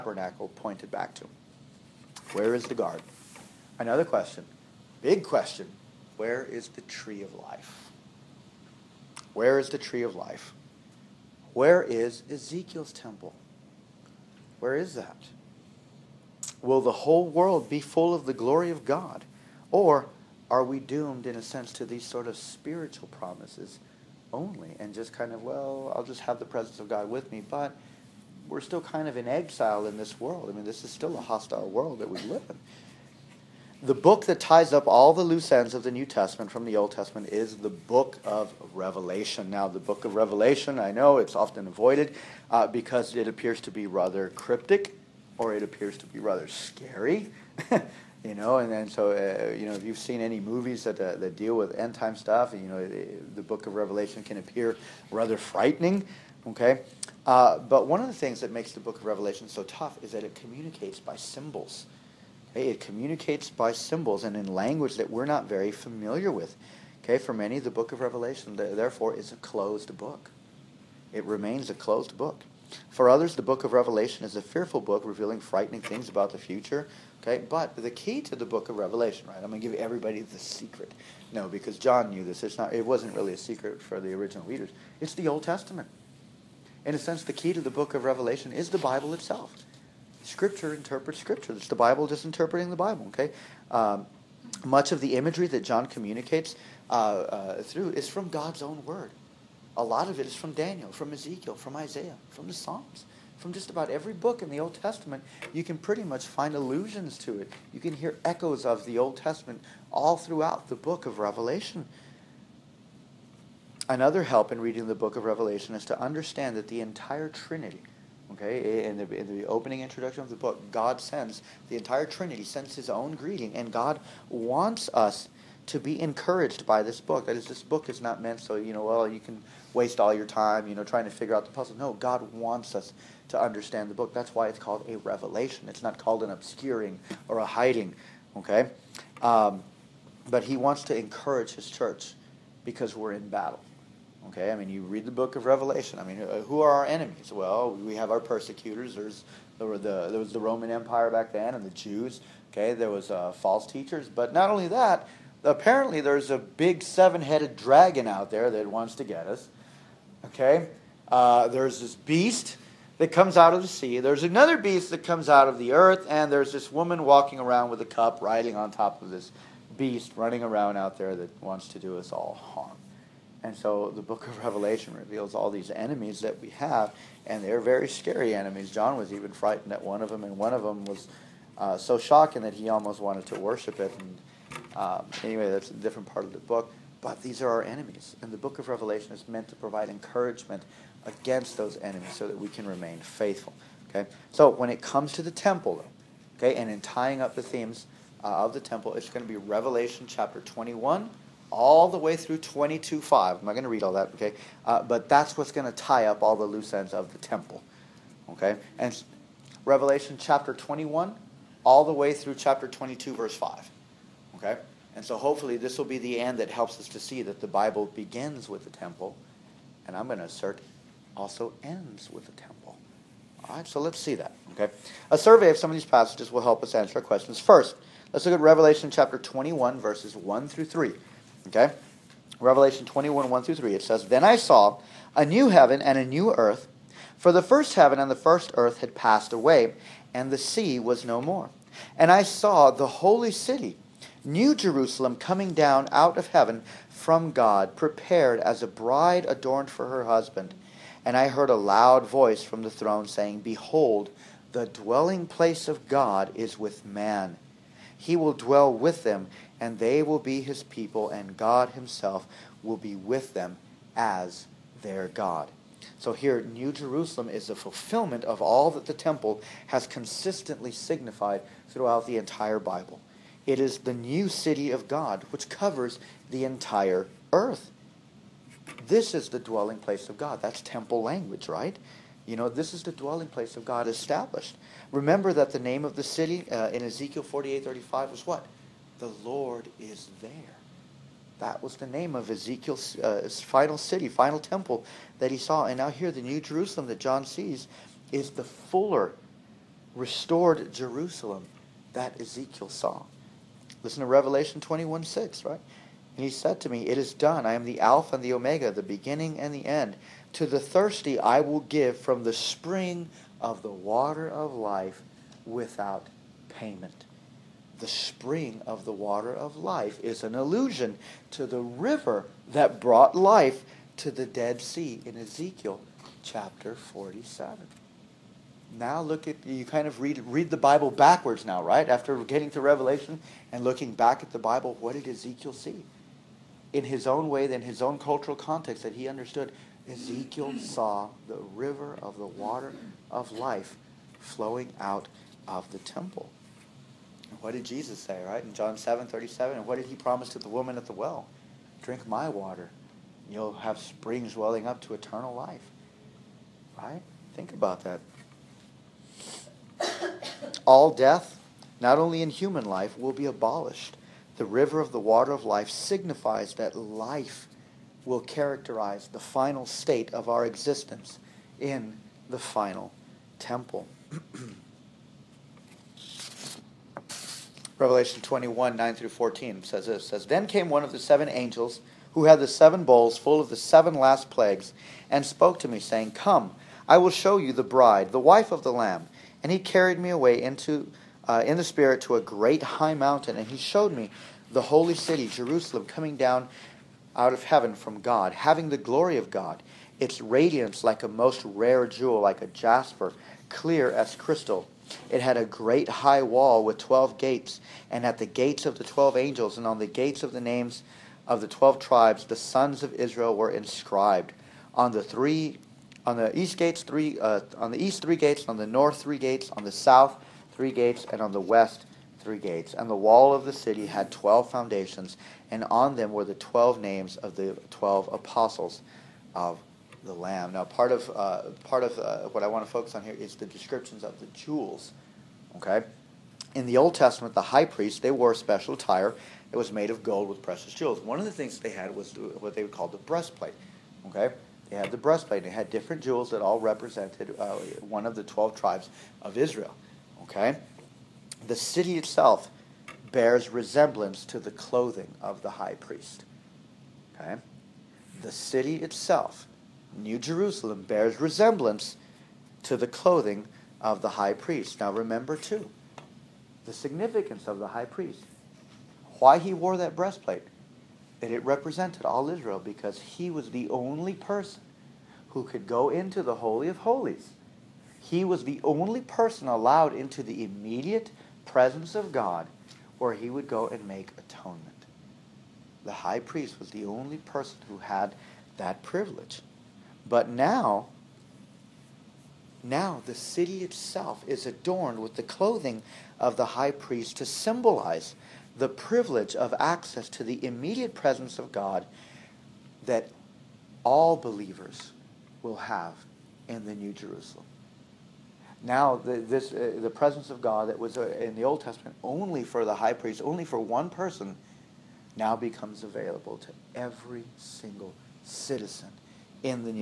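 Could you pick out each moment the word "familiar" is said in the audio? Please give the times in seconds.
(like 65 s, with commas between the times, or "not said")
65 s.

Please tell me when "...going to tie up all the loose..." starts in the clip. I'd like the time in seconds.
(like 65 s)
205 s.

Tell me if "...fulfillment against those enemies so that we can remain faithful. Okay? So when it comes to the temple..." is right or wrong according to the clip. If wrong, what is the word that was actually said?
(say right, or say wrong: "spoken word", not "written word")
wrong: "encouragement", not "fulfillment".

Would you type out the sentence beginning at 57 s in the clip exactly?
Uh, but one of the things that makes the book of Revelation so tough is that it communicates by symbols.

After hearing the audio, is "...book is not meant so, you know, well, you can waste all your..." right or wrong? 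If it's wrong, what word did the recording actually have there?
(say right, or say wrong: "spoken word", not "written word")
right.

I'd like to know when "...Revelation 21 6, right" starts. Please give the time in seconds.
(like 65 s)
304 s.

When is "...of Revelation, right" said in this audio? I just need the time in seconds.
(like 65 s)
78 s.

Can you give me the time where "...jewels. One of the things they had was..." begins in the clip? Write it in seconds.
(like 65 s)
440 s.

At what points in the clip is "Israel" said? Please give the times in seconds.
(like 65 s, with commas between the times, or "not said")
412 s, 449 s, 472 s.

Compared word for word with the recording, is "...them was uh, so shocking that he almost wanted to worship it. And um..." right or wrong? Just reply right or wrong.
right.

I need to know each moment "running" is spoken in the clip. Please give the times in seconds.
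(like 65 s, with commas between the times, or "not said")
170 s.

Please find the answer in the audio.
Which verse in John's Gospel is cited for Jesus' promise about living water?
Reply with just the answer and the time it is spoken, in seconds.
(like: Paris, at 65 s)
John 7:37, at 348 s.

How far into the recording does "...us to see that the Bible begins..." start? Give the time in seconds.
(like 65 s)
216 s.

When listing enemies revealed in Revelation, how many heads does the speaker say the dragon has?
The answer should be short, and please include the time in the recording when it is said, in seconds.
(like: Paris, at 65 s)
7, at 156 s.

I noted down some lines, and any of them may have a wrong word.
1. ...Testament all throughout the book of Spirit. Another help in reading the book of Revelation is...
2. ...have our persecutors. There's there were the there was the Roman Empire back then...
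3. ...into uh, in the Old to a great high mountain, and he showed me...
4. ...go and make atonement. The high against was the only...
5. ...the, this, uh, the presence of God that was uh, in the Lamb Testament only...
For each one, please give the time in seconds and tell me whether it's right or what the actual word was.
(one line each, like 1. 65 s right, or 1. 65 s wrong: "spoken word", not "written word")
1. 109 s wrong: "Revelation", not "Spirit"
2. 147 s right
3. 390 s wrong: "Spirit", not "Old"
4. 483 s wrong: "priest", not "against"
5. 508 s wrong: "Old", not "Lamb".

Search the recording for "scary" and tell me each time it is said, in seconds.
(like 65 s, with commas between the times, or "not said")
46 s, 177 s.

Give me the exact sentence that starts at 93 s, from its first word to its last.
Okay, um, much of the imagery that John communicates uh, uh, through is from God's own Word.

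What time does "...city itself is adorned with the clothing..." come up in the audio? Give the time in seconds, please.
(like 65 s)
493 s.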